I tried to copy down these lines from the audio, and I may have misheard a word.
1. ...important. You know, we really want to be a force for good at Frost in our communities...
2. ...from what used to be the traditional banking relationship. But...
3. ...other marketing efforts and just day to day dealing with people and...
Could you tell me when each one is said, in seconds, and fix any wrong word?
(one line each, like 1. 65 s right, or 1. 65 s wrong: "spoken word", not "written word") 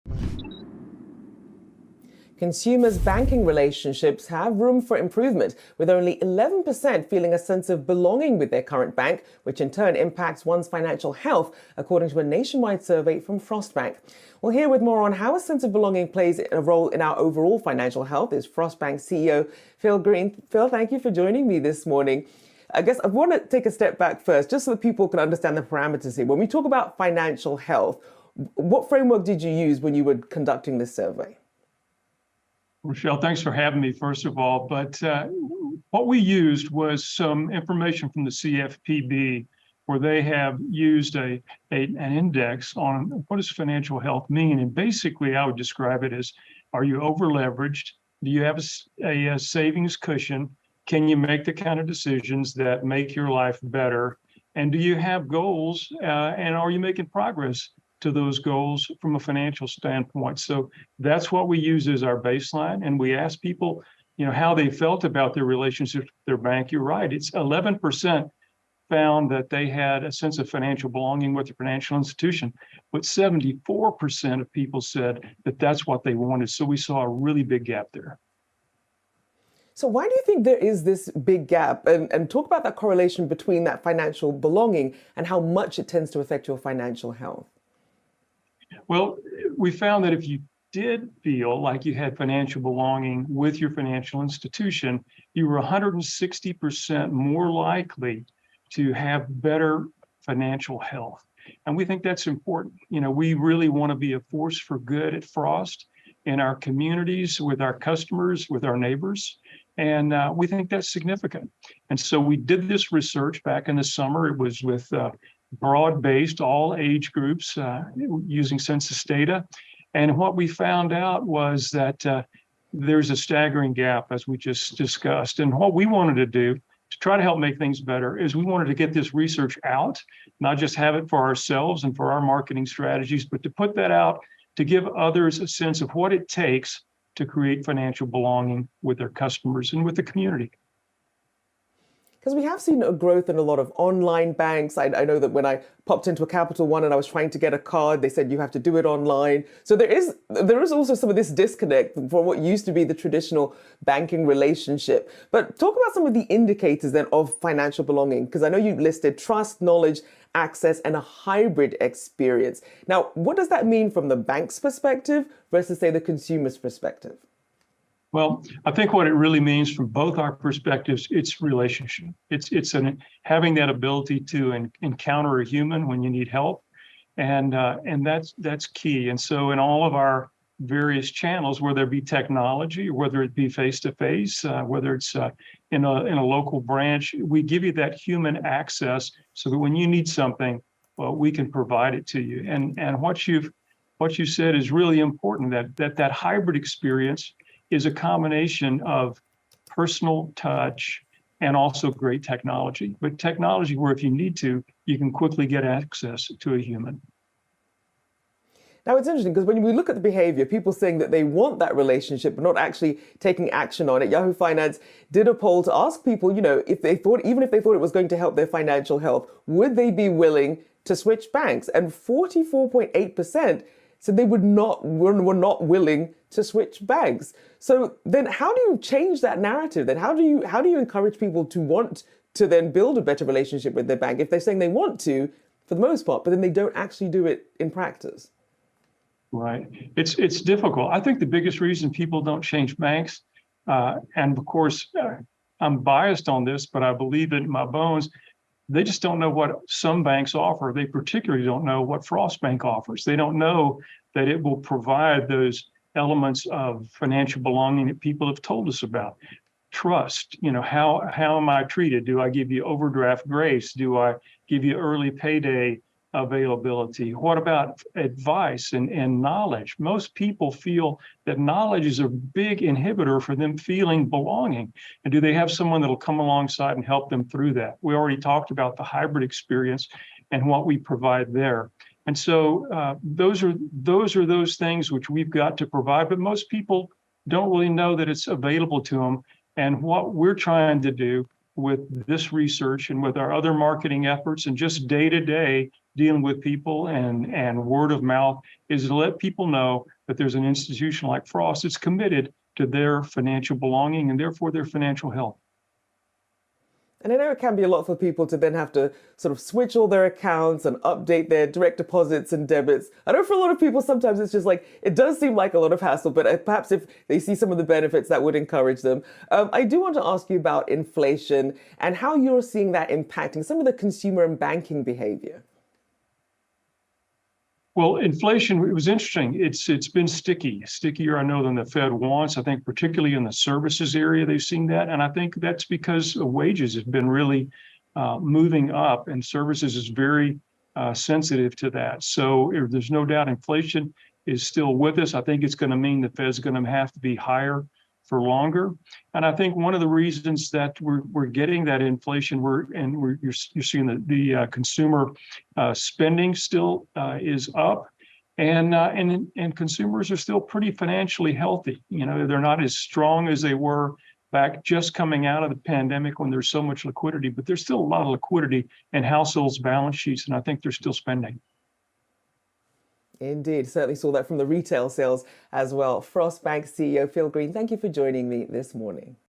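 1. 102 s right
2. 151 s right
3. 293 s right.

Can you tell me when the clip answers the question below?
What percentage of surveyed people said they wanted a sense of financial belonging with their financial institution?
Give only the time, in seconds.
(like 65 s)
73 s.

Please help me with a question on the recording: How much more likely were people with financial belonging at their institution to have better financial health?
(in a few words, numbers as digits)
160%.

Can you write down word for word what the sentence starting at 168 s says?
Well, I think what it really means from both our perspectives, it's relationship.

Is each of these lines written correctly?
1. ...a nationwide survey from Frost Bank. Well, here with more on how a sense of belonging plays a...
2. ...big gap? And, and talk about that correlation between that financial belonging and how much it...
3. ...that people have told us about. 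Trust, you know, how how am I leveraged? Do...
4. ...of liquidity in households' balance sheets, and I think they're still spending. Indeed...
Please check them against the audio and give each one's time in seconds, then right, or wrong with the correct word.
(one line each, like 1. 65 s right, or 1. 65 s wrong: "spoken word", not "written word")
1. 12 s right
2. 81 s right
3. 257 s wrong: "treated", not "leveraged"
4. 368 s right.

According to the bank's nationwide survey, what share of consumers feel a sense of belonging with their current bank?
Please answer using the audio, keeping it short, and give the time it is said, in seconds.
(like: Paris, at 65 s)
11%, at 5 s.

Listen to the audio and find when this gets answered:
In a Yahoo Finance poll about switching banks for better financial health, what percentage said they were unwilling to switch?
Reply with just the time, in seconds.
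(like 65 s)
221 s.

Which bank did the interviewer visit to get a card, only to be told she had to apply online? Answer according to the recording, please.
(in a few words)
Capital One.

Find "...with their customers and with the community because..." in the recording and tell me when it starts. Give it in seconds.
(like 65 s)
138 s.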